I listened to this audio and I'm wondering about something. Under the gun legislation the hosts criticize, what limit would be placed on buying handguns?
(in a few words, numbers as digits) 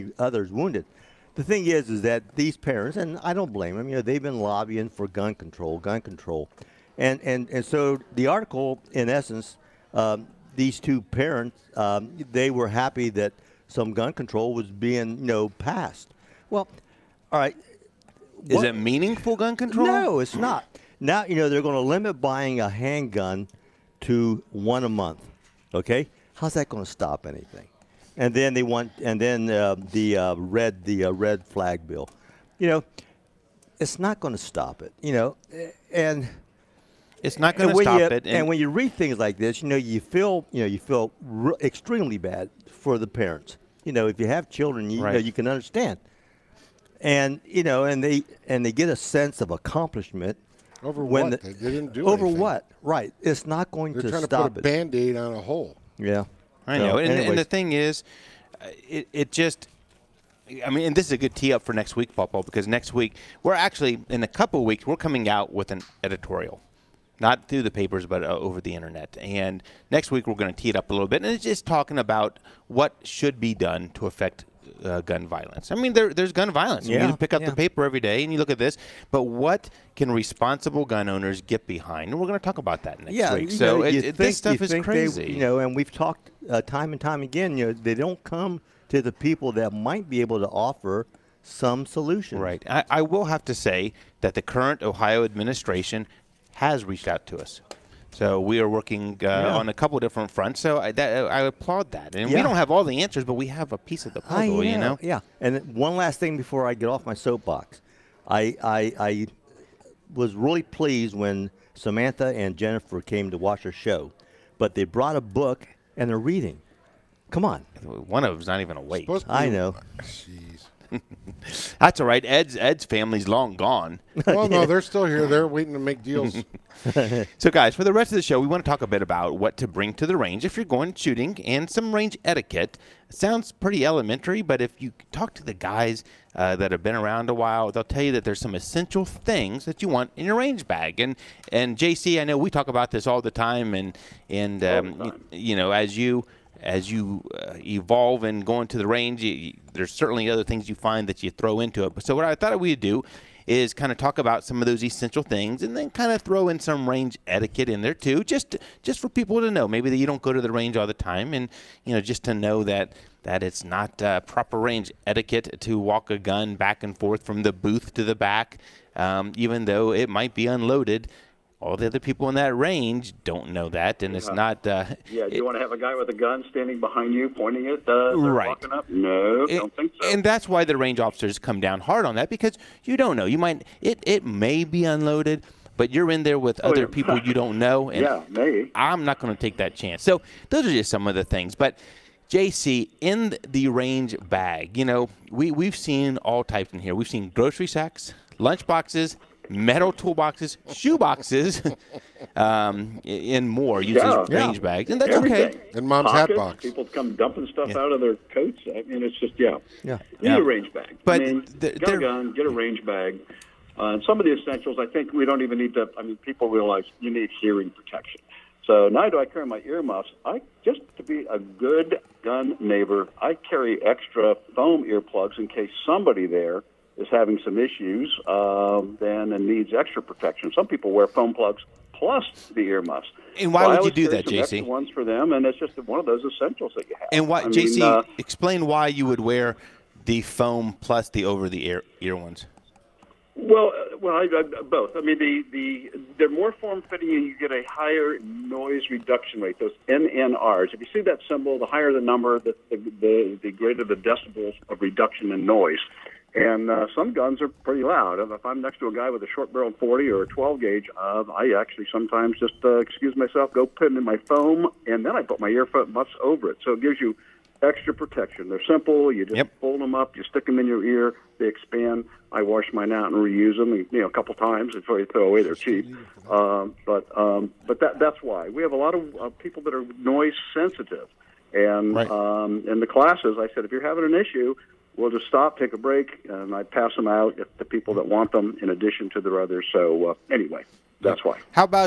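one a month.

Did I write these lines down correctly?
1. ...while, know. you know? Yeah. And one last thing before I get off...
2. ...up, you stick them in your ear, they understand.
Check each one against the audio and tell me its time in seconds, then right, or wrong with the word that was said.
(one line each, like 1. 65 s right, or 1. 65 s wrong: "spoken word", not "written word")
1. 104 s wrong: "puzzle", not "while"
2. 269 s wrong: "expand", not "understand".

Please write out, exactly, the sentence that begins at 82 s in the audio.
And we're going to talk about that next yeah, week.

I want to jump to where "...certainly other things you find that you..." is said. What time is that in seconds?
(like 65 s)
149 s.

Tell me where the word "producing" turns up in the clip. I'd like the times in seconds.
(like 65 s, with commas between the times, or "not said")
not said.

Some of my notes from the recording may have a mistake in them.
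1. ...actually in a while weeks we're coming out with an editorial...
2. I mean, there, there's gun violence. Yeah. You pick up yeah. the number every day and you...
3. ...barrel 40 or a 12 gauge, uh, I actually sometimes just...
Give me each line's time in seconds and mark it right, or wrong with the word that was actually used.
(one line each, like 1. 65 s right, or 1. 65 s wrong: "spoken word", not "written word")
1. 63 s wrong: "couple", not "while"
2. 75 s wrong: "paper", not "number"
3. 259 s right.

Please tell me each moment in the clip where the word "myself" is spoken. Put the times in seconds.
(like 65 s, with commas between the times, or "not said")
263 s.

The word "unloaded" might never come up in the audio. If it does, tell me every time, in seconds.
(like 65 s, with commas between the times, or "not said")
170 s, 184 s.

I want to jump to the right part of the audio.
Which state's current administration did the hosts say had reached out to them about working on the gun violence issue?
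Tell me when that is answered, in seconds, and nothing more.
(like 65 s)
94 s.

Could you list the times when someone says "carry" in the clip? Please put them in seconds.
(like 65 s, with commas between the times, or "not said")
219 s, 223 s.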